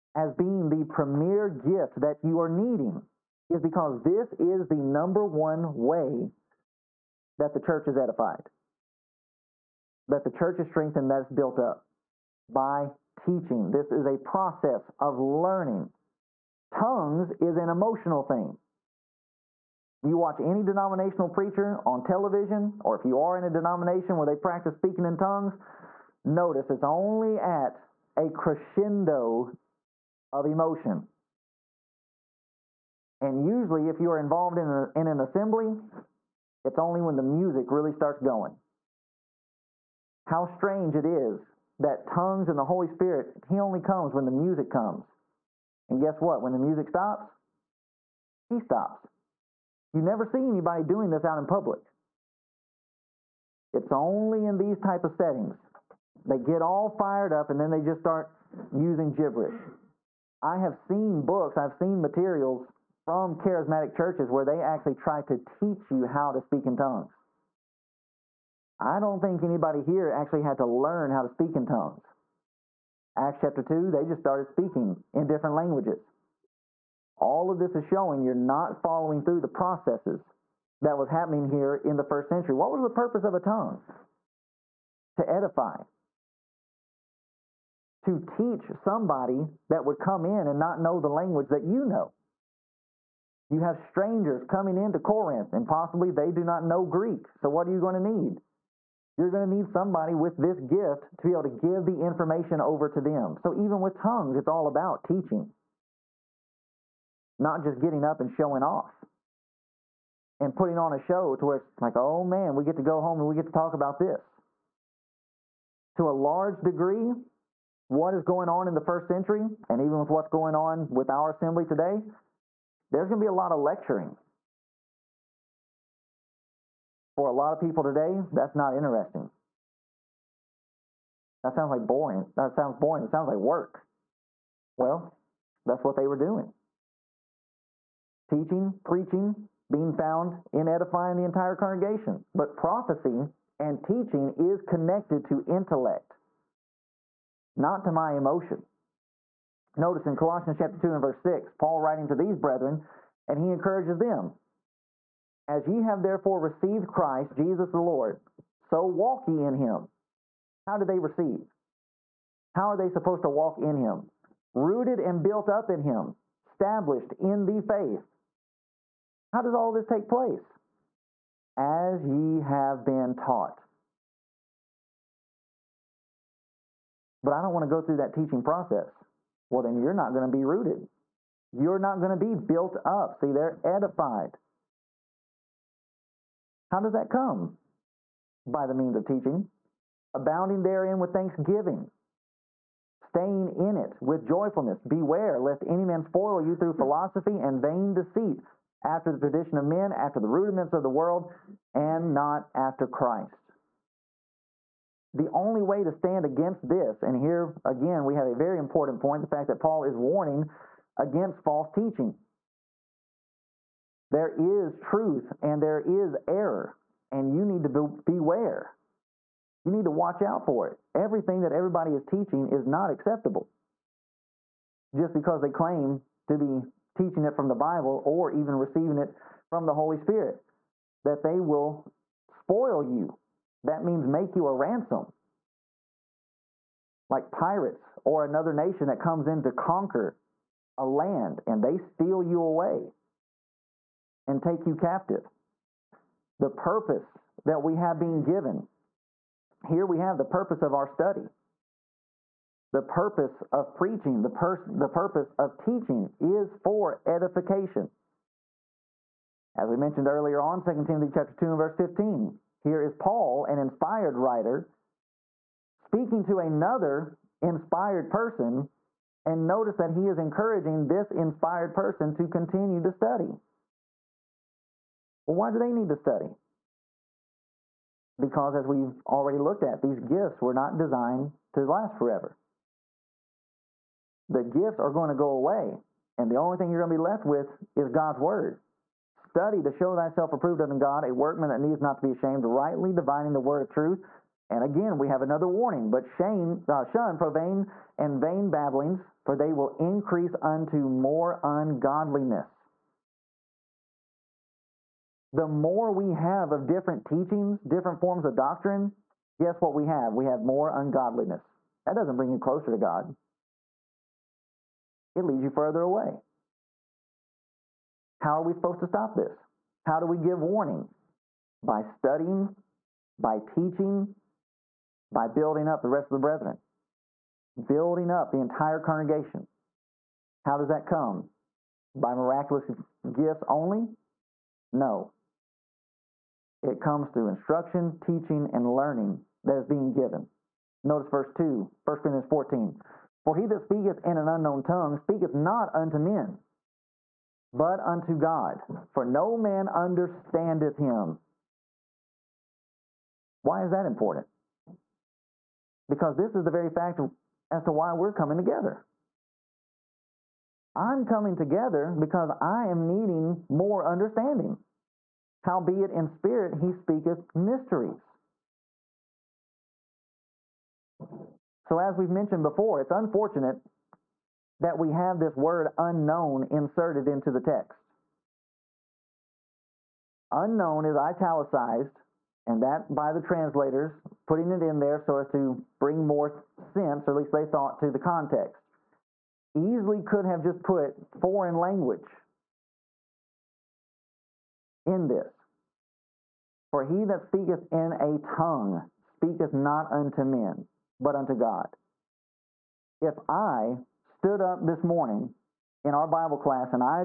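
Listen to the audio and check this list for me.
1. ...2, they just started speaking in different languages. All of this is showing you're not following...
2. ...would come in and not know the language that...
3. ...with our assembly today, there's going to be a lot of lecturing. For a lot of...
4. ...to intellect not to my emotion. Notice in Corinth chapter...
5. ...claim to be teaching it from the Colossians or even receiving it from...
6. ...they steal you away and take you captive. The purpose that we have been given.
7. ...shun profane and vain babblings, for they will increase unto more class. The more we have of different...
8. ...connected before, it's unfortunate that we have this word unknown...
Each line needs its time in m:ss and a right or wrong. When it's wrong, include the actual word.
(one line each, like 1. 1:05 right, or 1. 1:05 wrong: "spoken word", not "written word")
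1. 1:13 right
2. 1:29 right
3. 2:00 right
4. 2:25 wrong: "Colossians", not "Corinth"
5. 3:45 wrong: "Bible", not "Colossians"
6. 4:01 right
7. 4:56 wrong: "ungodliness", not "class"
8. 6:12 wrong: "mentioned", not "connected".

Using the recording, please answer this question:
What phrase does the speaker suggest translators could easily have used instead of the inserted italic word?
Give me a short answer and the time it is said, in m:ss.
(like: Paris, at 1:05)
foreign language, at 6:31.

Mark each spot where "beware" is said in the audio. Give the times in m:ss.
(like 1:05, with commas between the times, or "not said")
3:14, 3:38.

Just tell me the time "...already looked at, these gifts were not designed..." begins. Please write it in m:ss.
4:39.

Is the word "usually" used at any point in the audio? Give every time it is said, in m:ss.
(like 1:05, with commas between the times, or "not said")
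0:33.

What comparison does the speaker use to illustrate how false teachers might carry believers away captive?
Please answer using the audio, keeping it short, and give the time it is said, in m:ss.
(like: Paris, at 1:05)
Pirates, at 3:57.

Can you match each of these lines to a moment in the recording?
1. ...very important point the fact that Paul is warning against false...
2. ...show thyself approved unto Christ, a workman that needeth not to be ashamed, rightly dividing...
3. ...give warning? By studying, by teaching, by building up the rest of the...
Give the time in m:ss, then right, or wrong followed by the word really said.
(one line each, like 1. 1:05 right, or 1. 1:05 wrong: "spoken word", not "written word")
1. 3:28 right
2. 4:49 wrong: "God", not "Christ"
3. 5:20 right.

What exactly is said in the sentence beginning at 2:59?
Well, then you're not going to be rooted.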